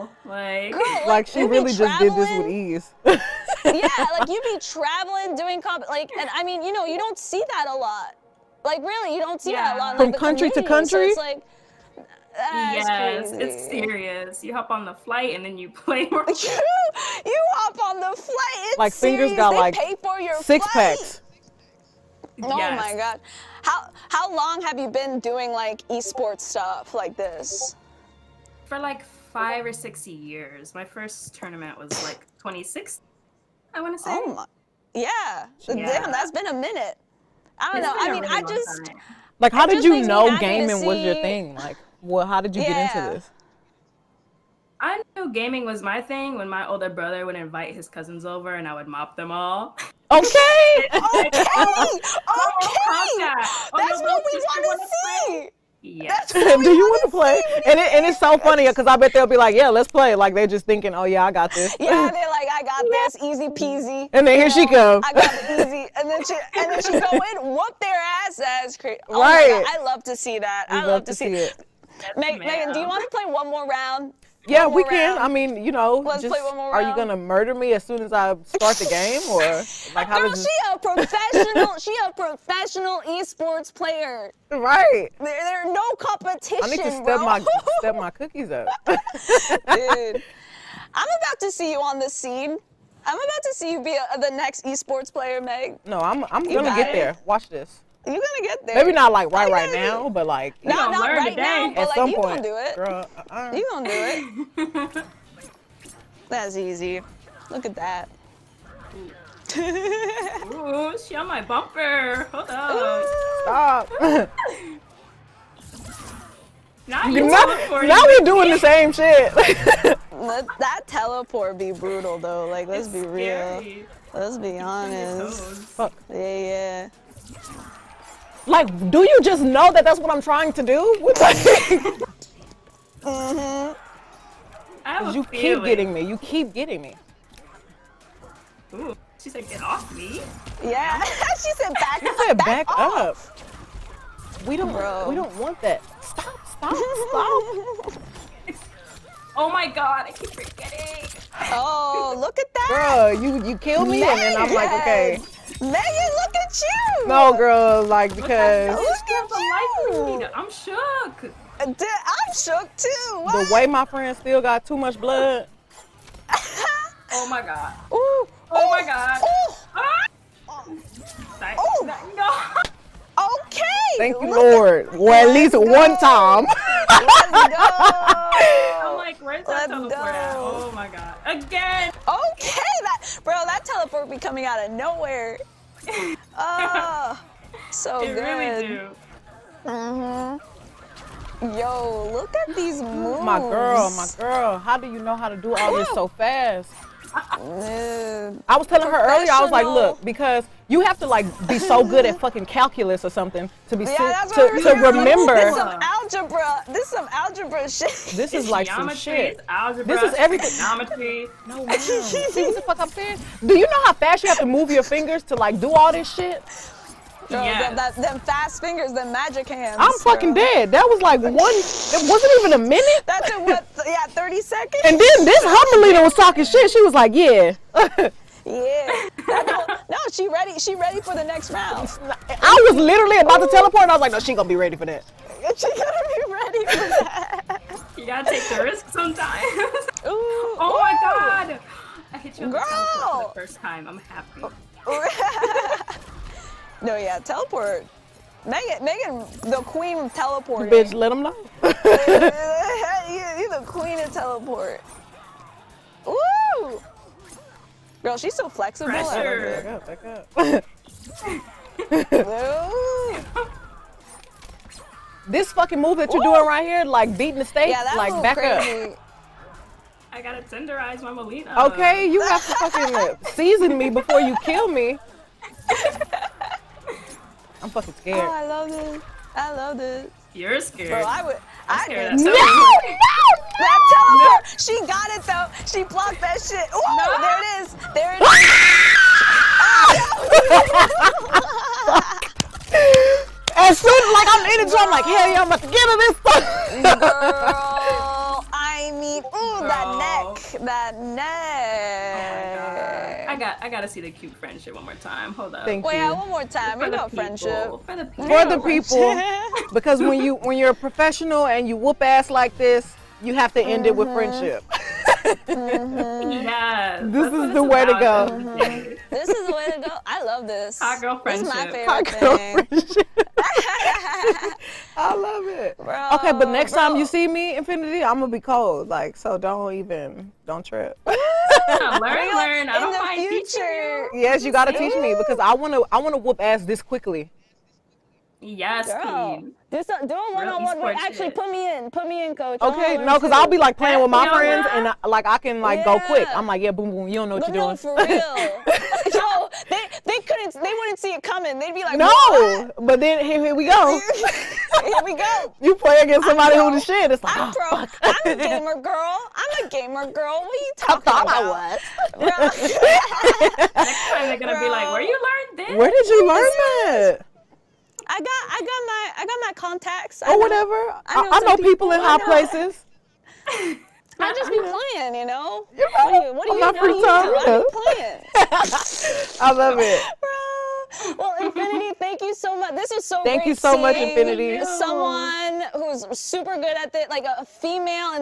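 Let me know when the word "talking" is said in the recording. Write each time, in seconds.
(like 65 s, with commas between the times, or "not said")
226 s, 360 s.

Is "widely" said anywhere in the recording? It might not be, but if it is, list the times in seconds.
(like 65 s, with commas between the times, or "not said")
not said.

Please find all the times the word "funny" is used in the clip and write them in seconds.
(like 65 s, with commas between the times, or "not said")
58 s.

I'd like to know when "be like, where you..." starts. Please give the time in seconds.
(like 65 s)
364 s.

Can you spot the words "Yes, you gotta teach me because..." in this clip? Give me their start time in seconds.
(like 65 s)
334 s.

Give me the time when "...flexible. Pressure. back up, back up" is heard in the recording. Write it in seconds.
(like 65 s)
258 s.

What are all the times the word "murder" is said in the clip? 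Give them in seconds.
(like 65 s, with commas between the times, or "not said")
77 s.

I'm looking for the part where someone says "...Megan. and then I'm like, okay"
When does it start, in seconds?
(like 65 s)
154 s.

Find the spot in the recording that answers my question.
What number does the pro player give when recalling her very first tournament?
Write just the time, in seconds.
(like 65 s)
32 s.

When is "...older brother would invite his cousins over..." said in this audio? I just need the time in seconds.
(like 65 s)
46 s.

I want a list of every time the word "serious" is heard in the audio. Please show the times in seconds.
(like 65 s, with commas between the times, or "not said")
13 s, 18 s.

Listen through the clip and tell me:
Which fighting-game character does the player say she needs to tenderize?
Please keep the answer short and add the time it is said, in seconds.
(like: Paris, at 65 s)
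Mileena, at 271 s.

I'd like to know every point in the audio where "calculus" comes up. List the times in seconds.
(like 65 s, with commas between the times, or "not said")
202 s.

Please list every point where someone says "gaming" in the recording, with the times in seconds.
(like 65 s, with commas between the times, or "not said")
40 s, 45 s.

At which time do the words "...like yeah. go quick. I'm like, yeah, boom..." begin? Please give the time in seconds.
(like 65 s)
345 s.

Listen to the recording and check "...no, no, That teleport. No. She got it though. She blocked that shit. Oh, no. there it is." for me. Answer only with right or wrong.
right.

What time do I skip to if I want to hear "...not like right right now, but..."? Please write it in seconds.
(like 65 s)
98 s.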